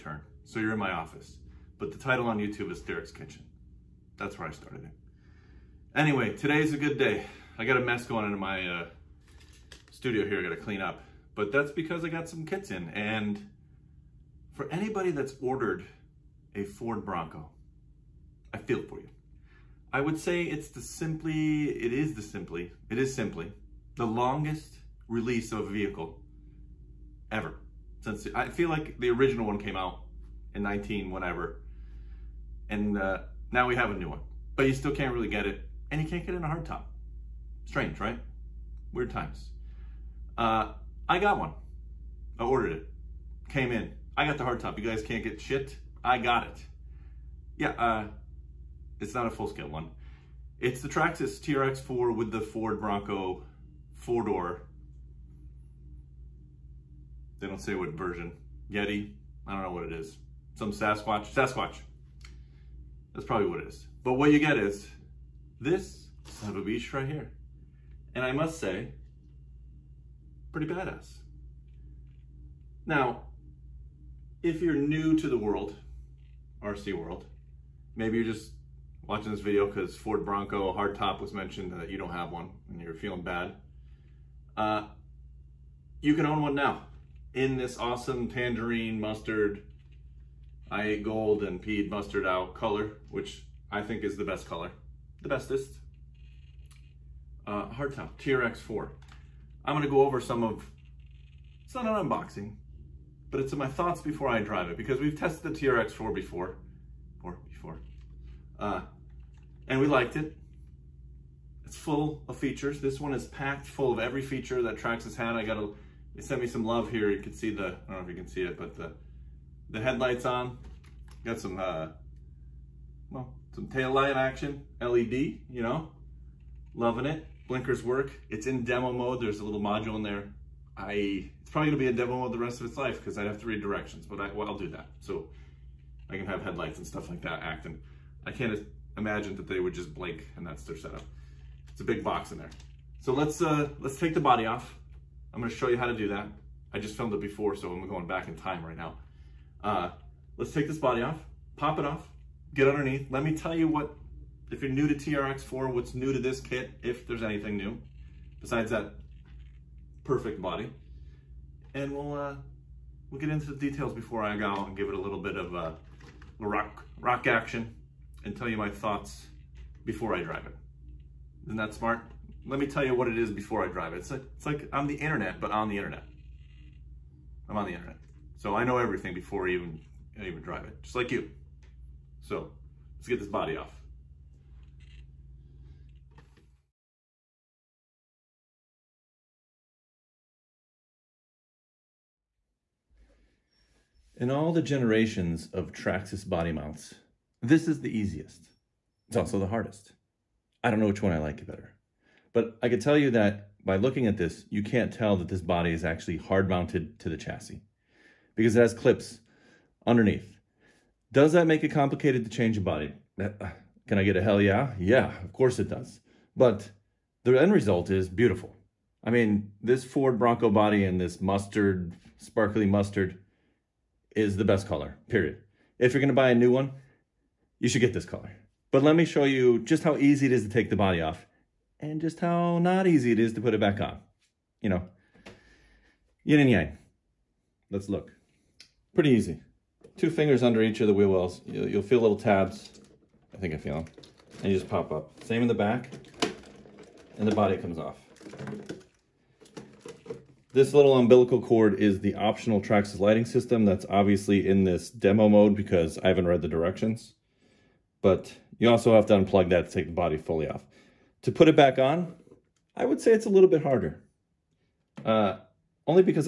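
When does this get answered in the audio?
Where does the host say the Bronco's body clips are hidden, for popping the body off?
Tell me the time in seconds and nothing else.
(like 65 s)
240 s.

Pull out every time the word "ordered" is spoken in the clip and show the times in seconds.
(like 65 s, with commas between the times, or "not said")
15 s, 42 s.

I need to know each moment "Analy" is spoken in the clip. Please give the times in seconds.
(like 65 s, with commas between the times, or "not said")
not said.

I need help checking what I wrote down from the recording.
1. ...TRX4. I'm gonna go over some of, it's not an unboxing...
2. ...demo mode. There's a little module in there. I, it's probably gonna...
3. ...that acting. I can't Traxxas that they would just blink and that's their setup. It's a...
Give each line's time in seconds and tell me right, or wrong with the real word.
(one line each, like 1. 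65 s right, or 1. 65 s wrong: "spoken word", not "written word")
1. 98 s right
2. 128 s right
3. 137 s wrong: "Imagine", not "Traxxas".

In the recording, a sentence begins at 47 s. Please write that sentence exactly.
Yeah, uh, it's not a full-scale one.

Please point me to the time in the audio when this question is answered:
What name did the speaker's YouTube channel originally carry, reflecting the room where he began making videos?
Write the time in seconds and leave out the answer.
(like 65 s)
2 s.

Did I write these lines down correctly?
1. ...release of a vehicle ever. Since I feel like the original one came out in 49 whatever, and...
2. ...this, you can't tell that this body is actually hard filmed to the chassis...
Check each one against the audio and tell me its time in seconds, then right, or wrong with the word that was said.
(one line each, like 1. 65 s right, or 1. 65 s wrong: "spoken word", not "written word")
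1. 25 s wrong: "19", not "49"
2. 204 s wrong: "mounted", not "filmed".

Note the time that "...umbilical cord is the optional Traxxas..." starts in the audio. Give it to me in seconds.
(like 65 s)
250 s.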